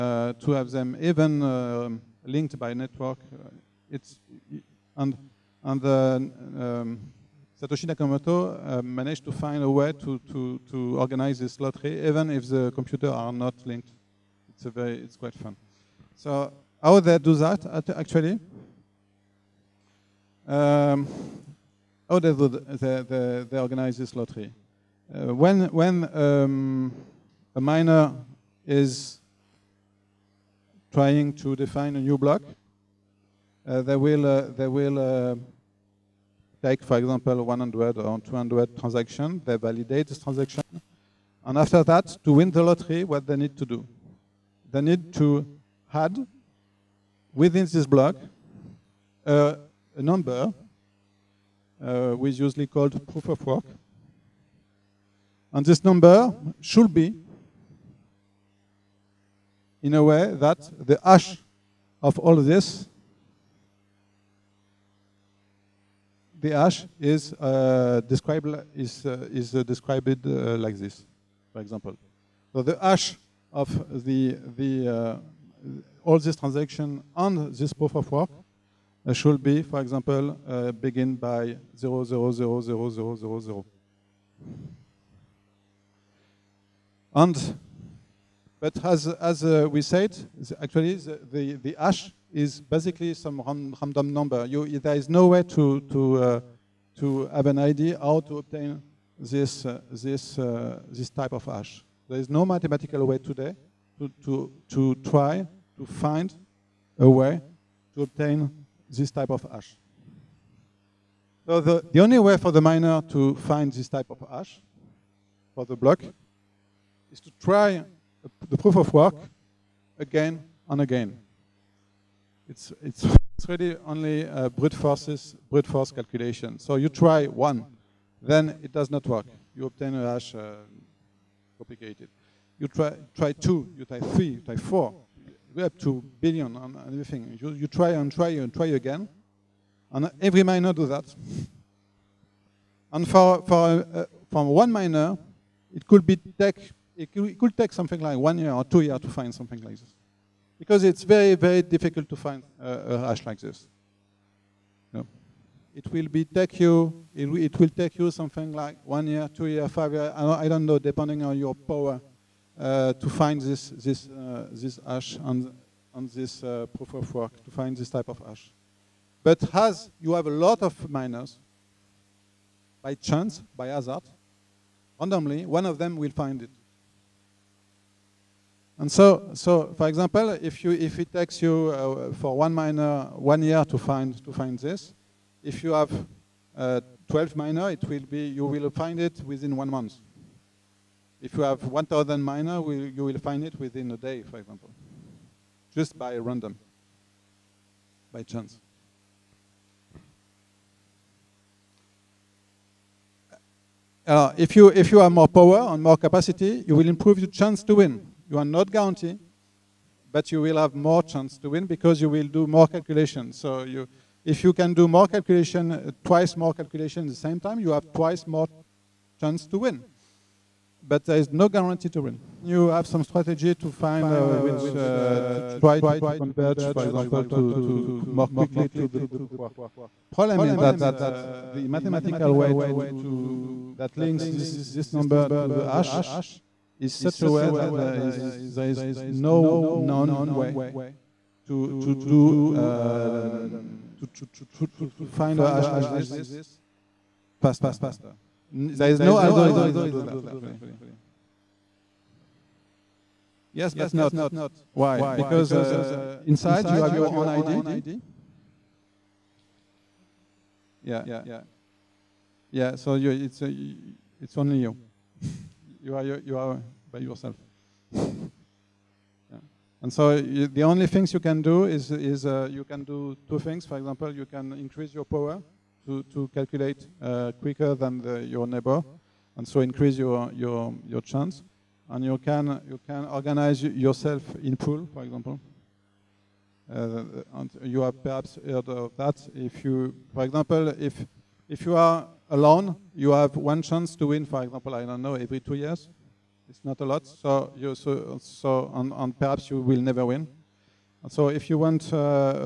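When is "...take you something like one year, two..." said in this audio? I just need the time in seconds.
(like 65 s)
157 s.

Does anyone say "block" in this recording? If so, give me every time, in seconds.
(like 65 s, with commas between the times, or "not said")
32 s, 47 s, 115 s.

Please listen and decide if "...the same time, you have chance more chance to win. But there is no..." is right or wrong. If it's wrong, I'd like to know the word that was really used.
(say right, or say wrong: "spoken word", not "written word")
wrong: "twice", not "chance".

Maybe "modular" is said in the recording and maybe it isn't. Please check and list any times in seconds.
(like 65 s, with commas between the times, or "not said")
not said.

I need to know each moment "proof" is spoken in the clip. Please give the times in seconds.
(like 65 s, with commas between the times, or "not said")
53 s, 77 s, 118 s, 166 s, 228 s.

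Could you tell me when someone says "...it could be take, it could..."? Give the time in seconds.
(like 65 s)
145 s.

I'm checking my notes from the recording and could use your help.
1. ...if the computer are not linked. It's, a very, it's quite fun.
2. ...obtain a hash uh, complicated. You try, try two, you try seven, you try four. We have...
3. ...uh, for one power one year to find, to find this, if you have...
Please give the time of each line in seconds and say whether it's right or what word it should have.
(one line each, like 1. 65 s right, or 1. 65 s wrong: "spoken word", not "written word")
1. 12 s right
2. 129 s wrong: "three", not "seven"
3. 181 s wrong: "miner", not "power".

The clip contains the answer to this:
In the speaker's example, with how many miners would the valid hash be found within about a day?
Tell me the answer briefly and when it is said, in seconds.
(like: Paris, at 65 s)
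1,000, at 191 s.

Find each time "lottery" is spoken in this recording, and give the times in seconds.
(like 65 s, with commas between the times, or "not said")
11 s, 24 s, 42 s.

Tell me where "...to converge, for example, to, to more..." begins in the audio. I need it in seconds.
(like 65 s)
225 s.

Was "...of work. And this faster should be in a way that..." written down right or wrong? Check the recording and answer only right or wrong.
wrong.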